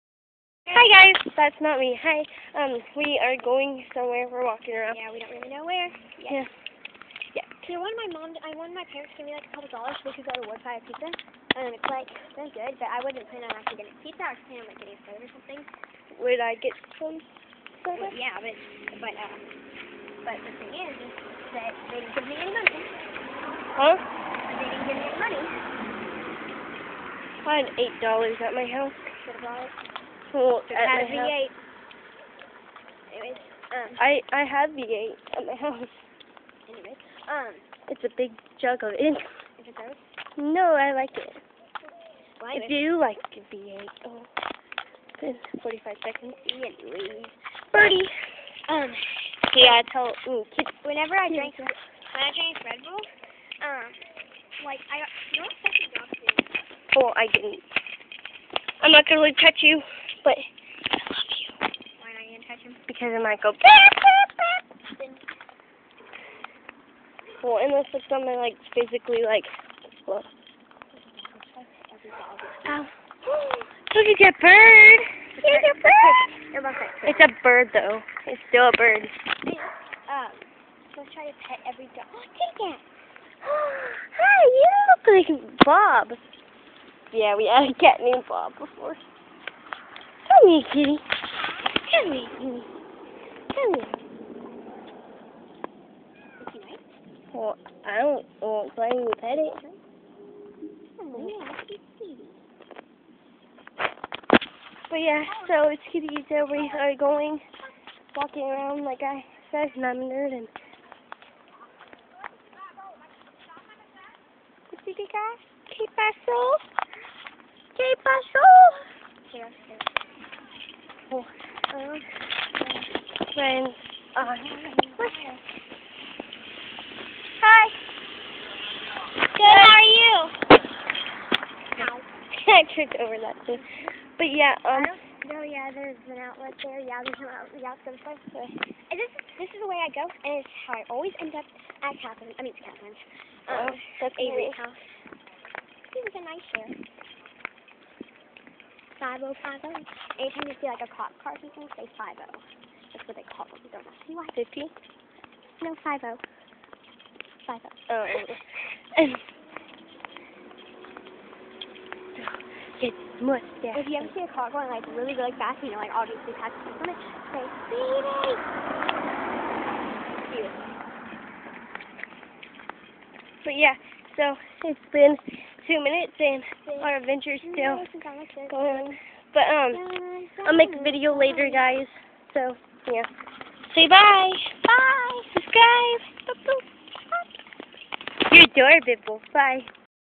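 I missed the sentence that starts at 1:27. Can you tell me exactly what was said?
Yeah, we had a cat named Bob before.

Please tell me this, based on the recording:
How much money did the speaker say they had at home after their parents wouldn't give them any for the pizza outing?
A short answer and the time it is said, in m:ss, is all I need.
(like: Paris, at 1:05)
8 dollars, at 0:27.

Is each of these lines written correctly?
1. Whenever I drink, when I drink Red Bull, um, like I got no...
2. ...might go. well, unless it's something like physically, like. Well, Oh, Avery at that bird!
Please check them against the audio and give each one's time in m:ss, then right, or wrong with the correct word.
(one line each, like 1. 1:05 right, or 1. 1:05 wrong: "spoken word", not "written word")
1. 0:50 right
2. 1:03 wrong: "Look", not "Avery".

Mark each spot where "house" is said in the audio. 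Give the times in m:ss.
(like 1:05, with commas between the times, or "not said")
0:28, 0:35, 2:24.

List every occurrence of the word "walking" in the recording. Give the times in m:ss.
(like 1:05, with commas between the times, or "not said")
0:04, 1:48.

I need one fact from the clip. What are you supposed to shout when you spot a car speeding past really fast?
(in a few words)
Baby.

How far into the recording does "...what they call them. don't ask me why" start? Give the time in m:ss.
2:33.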